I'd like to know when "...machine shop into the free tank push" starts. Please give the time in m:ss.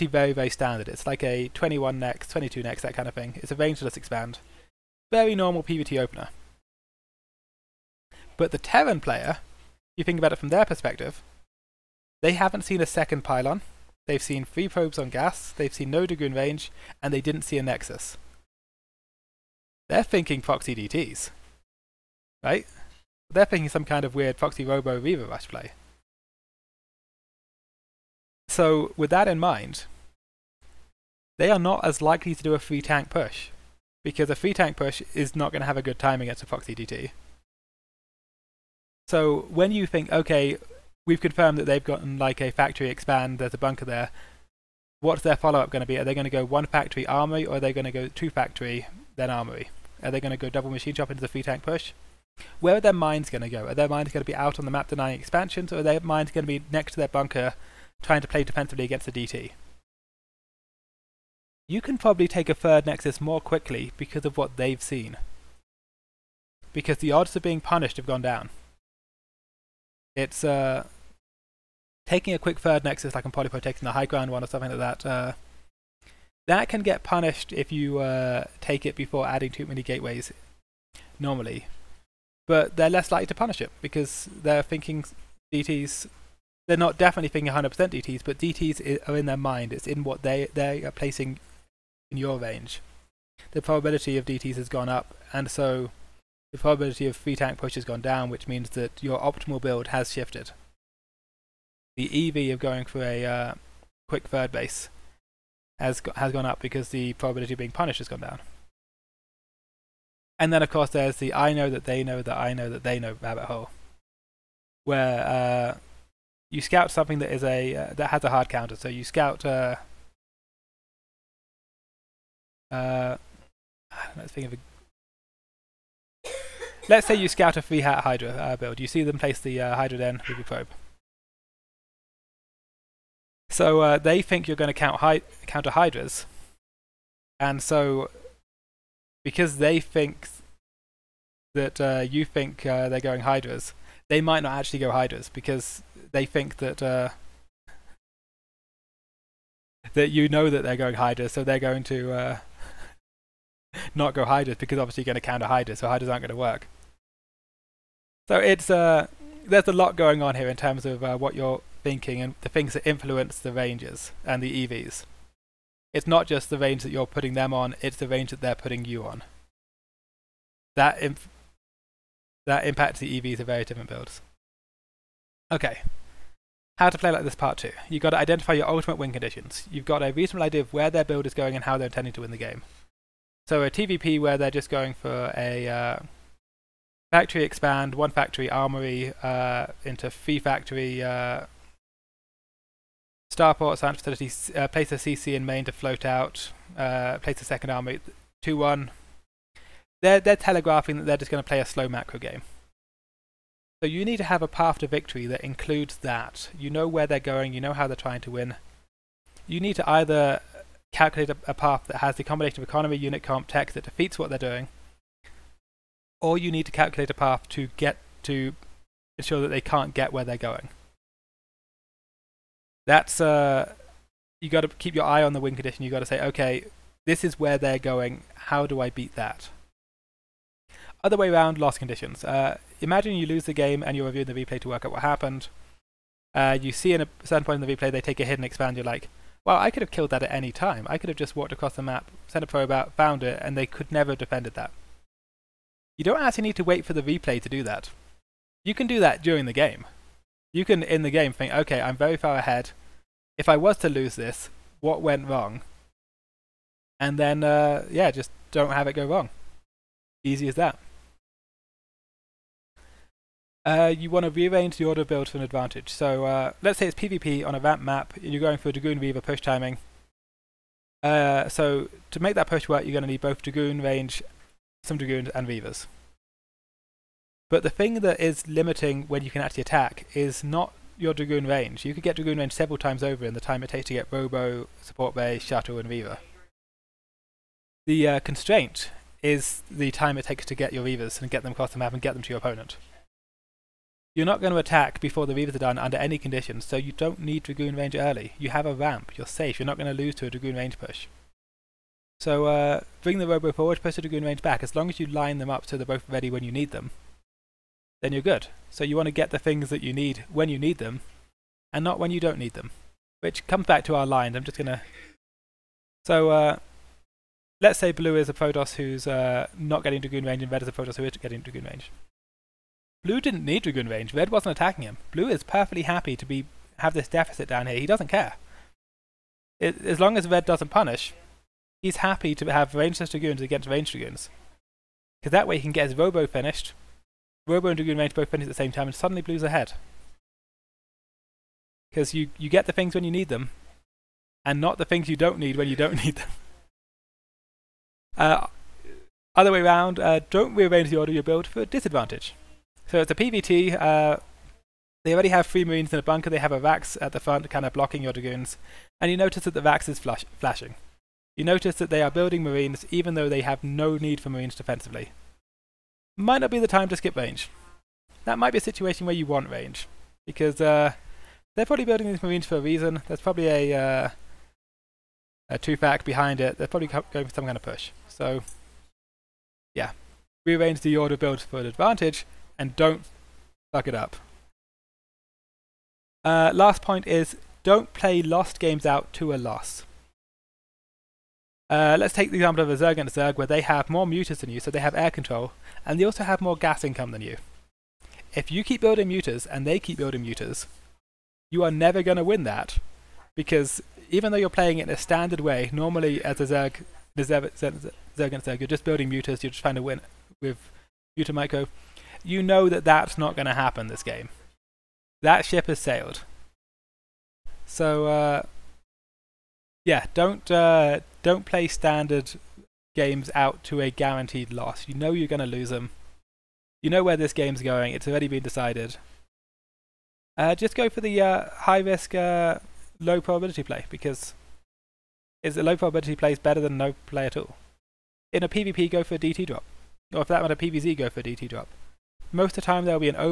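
0:50.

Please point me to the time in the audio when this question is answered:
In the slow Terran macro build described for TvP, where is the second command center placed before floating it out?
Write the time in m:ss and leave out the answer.
3:14.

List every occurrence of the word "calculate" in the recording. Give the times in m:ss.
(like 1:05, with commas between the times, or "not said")
3:30, 3:36.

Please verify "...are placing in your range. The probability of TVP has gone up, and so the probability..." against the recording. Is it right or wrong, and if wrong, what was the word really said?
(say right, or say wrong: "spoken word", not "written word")
wrong: "DTs", not "TVP".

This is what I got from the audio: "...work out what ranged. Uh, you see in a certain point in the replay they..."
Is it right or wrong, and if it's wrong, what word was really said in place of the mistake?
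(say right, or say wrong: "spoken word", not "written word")
wrong: "happened", not "ranged".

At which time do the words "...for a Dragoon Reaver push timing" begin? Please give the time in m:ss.
4:28.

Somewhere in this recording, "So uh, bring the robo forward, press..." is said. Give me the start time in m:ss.
5:02.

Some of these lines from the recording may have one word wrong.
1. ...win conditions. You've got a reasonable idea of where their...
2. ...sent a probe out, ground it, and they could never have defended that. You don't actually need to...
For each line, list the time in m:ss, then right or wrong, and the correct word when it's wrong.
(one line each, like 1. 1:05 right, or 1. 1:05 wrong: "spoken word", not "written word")
1. 2:58 right
2. 4:02 wrong: "found", not "ground".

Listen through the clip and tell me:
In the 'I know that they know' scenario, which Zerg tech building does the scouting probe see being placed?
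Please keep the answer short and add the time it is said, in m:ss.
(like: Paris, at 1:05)
Hydra den, at 2:09.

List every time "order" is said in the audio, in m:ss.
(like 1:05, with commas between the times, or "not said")
4:24, 5:50, 6:20.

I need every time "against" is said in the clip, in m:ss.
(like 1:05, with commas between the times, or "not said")
0:36, 0:58, 5:33.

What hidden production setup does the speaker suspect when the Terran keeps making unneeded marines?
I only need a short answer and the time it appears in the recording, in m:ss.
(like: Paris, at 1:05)
a two-fac, at 6:15.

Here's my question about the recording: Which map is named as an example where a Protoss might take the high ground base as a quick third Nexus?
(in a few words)
Polypoid.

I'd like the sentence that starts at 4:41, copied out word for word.
You could get Dragoon range several times over in the time it takes to get Robo, Support Bay, Shuttle and Reaver.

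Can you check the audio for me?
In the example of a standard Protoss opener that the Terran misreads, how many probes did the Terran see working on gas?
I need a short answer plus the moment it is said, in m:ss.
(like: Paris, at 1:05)
3, at 0:14.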